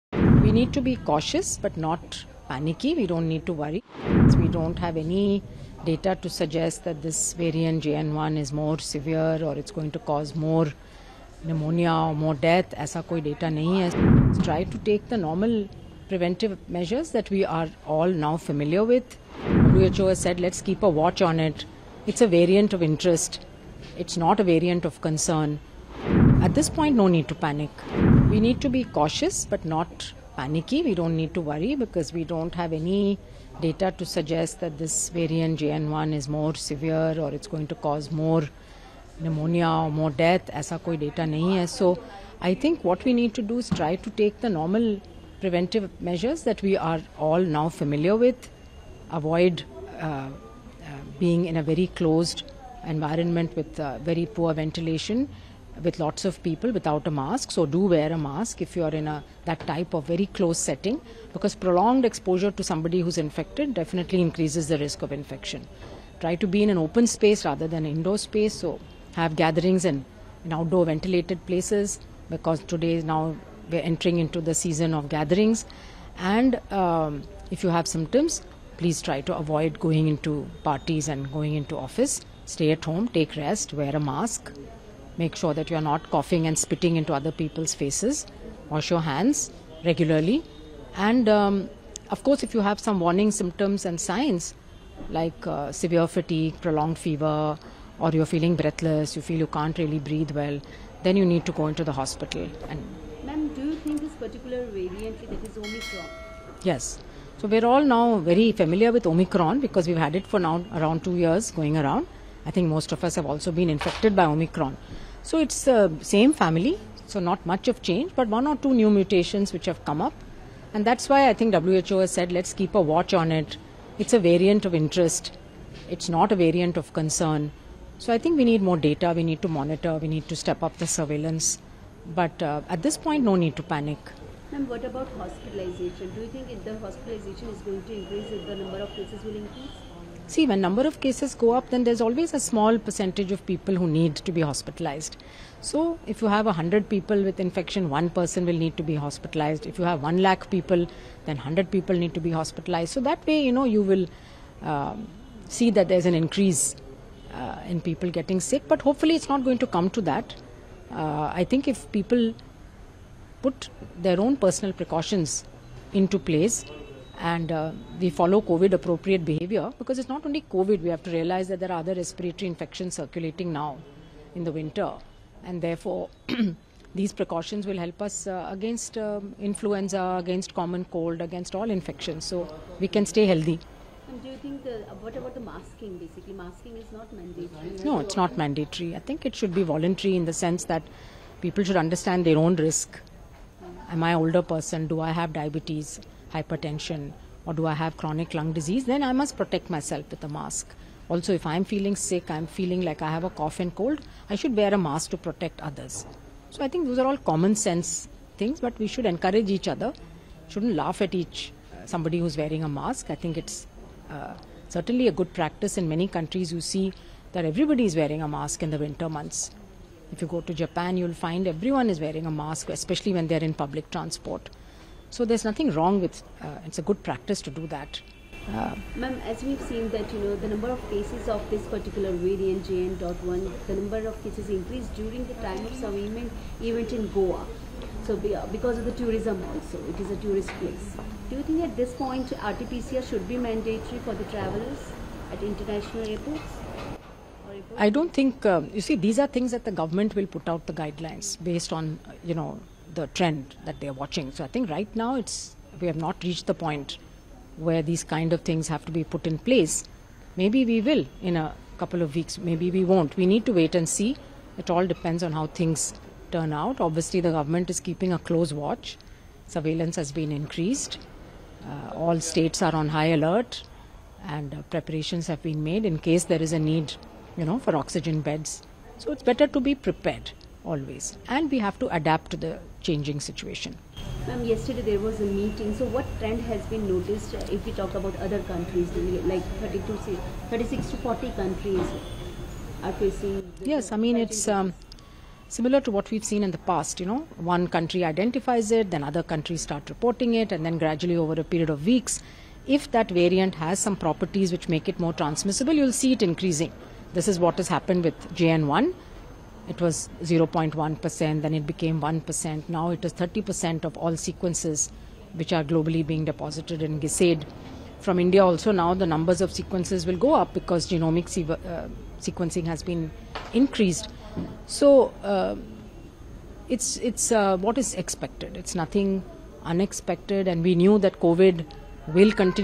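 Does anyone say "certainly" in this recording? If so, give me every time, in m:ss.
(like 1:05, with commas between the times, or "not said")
3:34.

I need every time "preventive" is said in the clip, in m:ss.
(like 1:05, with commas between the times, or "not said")
0:16, 0:45.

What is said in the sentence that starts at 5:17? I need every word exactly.
From India also now the numbers of sequences will go up because genomic se uh, sequencing has been increased.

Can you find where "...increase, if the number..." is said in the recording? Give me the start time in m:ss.
2:17.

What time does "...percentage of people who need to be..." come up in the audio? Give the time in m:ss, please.
2:22.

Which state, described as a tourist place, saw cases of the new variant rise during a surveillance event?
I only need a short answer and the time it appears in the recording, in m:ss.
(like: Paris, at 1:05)
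Goa, at 3:57.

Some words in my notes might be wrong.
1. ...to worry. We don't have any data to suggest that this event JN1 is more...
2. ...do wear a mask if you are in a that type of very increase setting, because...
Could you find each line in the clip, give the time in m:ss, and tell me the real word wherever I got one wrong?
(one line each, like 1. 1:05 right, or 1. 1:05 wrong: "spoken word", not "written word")
1. 0:03 wrong: "variant", not "event"
2. 0:57 wrong: "close", not "increase".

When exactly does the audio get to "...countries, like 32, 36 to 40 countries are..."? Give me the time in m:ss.
4:48.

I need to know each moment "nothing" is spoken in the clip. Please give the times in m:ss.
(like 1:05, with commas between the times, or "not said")
3:45, 5:28.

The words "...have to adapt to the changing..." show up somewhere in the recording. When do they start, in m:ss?
4:41.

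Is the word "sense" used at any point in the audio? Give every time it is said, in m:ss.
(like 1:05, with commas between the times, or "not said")
3:10, 3:27.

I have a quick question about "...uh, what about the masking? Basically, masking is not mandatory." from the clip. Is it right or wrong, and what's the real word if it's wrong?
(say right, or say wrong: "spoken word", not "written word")
right.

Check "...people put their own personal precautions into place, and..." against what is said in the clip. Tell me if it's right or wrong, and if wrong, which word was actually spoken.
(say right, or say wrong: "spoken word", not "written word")
right.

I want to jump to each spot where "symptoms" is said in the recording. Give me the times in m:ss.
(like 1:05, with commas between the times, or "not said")
1:17, 1:33.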